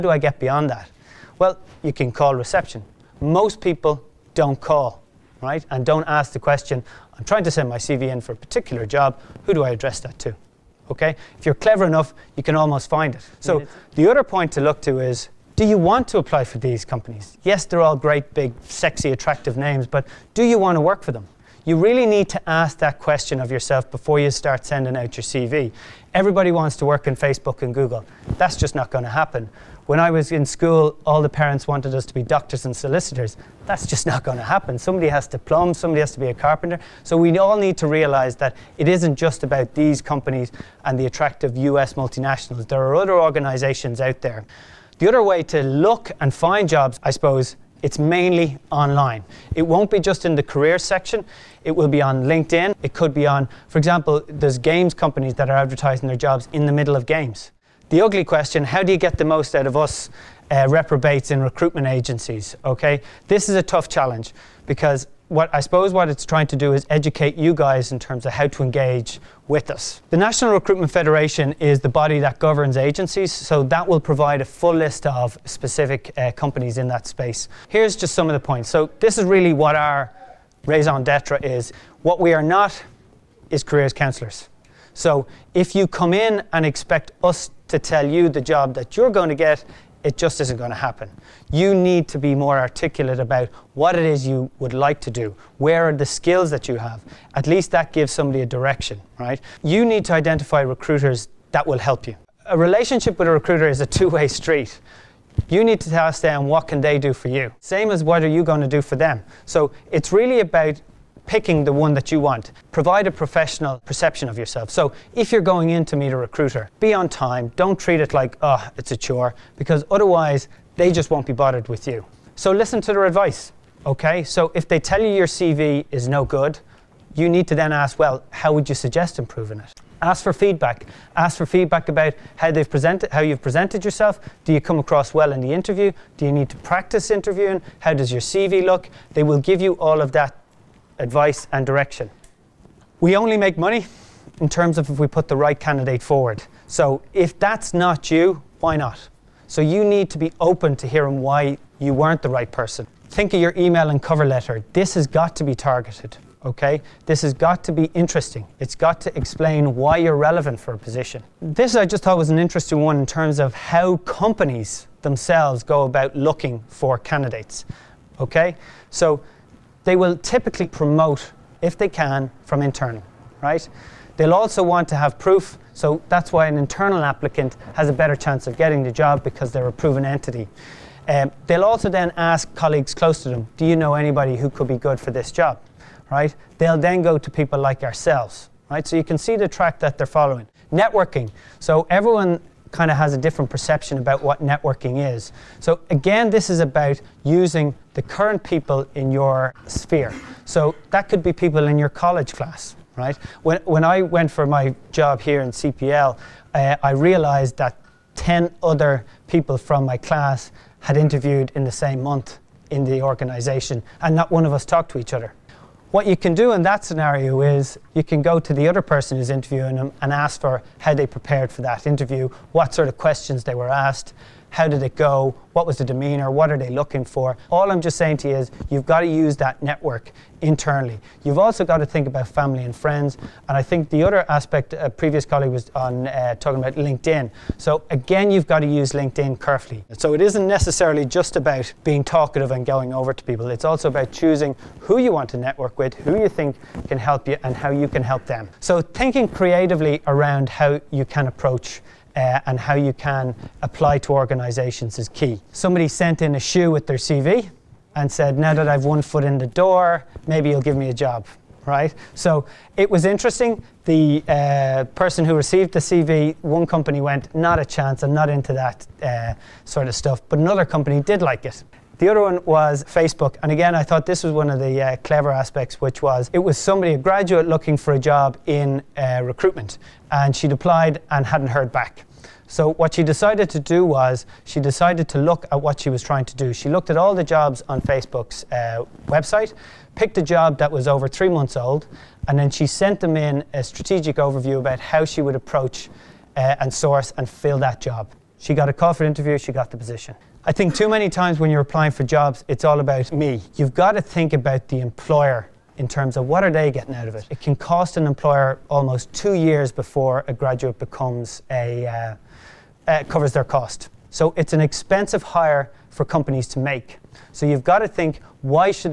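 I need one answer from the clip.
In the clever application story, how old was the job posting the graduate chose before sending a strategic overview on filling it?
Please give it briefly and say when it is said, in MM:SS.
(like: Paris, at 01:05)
Over 3 months, at 04:50.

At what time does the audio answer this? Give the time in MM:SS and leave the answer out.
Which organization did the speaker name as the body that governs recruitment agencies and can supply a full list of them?
01:10.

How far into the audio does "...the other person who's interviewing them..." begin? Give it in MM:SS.
03:38.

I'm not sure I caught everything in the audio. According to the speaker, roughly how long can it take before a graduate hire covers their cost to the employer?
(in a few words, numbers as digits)
Almost 2 years.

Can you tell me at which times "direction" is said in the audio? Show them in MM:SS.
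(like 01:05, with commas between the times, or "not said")
01:38, 02:21.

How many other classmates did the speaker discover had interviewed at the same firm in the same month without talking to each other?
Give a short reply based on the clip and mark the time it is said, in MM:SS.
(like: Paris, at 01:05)
10, at 03:28.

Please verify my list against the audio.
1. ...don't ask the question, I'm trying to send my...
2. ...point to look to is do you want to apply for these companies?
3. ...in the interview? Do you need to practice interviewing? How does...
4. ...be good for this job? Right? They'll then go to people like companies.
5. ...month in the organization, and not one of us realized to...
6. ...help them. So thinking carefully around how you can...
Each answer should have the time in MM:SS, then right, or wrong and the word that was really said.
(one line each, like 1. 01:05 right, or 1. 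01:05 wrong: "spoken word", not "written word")
1. 00:05 right
2. 00:14 right
3. 02:15 right
4. 03:04 wrong: "ourselves", not "companies"
5. 03:32 wrong: "talked", not "realized"
6. 04:08 wrong: "creatively", not "carefully".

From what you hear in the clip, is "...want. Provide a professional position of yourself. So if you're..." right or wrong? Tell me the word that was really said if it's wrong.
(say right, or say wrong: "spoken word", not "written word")
wrong: "perception", not "position".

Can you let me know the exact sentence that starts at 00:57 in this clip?
The ugly question, how do you get the most out of us uh, reprobates in recruitment agencies, okay?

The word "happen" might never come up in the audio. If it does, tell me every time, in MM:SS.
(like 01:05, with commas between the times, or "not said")
00:29, 00:34, 01:30.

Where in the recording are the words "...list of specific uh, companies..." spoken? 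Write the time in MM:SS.
01:14.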